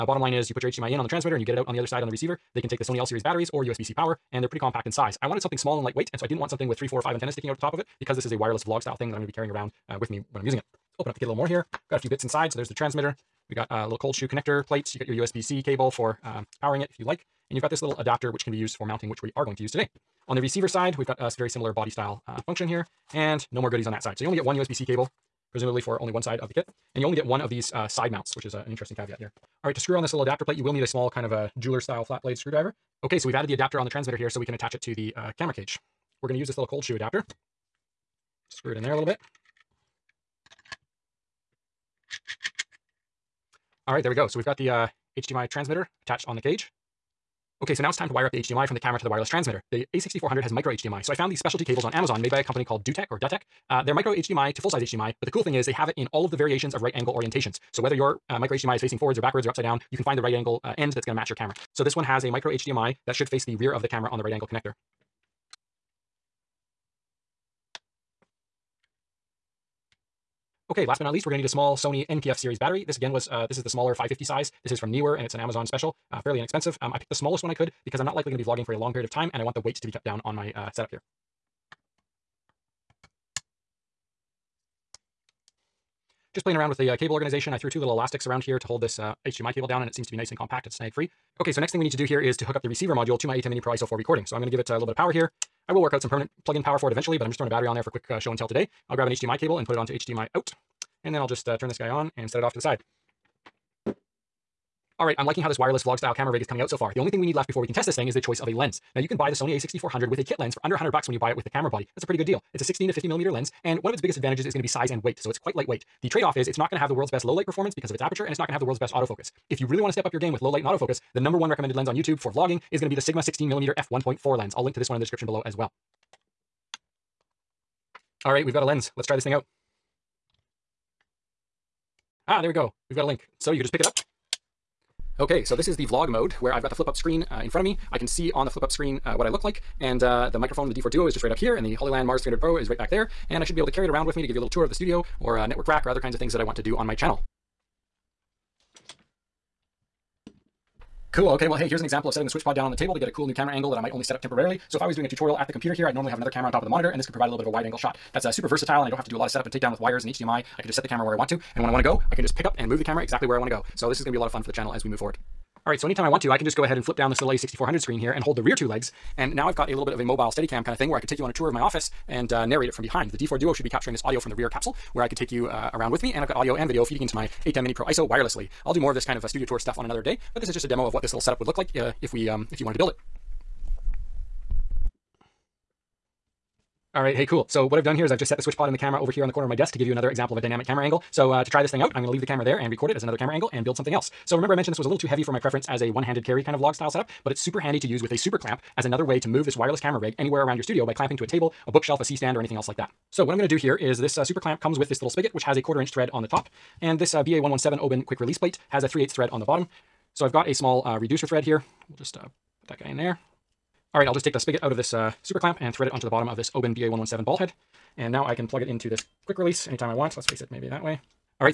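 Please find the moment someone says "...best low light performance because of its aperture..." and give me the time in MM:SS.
01:57.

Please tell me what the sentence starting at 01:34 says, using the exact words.
So I'm gonna give it uh, a little bit of power here.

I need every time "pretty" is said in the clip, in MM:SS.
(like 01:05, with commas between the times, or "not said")
00:04, 01:52.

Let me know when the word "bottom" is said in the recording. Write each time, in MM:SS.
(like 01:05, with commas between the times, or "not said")
00:00, 03:29, 03:36.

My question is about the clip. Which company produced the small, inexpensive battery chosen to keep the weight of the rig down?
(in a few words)
Neewer.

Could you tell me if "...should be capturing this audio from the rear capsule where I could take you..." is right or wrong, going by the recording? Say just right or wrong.
right.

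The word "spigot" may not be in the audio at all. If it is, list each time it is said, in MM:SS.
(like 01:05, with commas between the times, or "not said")
03:25, 03:34.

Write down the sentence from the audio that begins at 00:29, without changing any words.
All right, to screw on this little adapter plate, you will need a small kind of a jeweler style flat blade screwdriver.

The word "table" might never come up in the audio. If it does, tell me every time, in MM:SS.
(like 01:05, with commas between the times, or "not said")
02:32, 03:21.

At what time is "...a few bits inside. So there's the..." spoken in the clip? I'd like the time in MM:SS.
00:11.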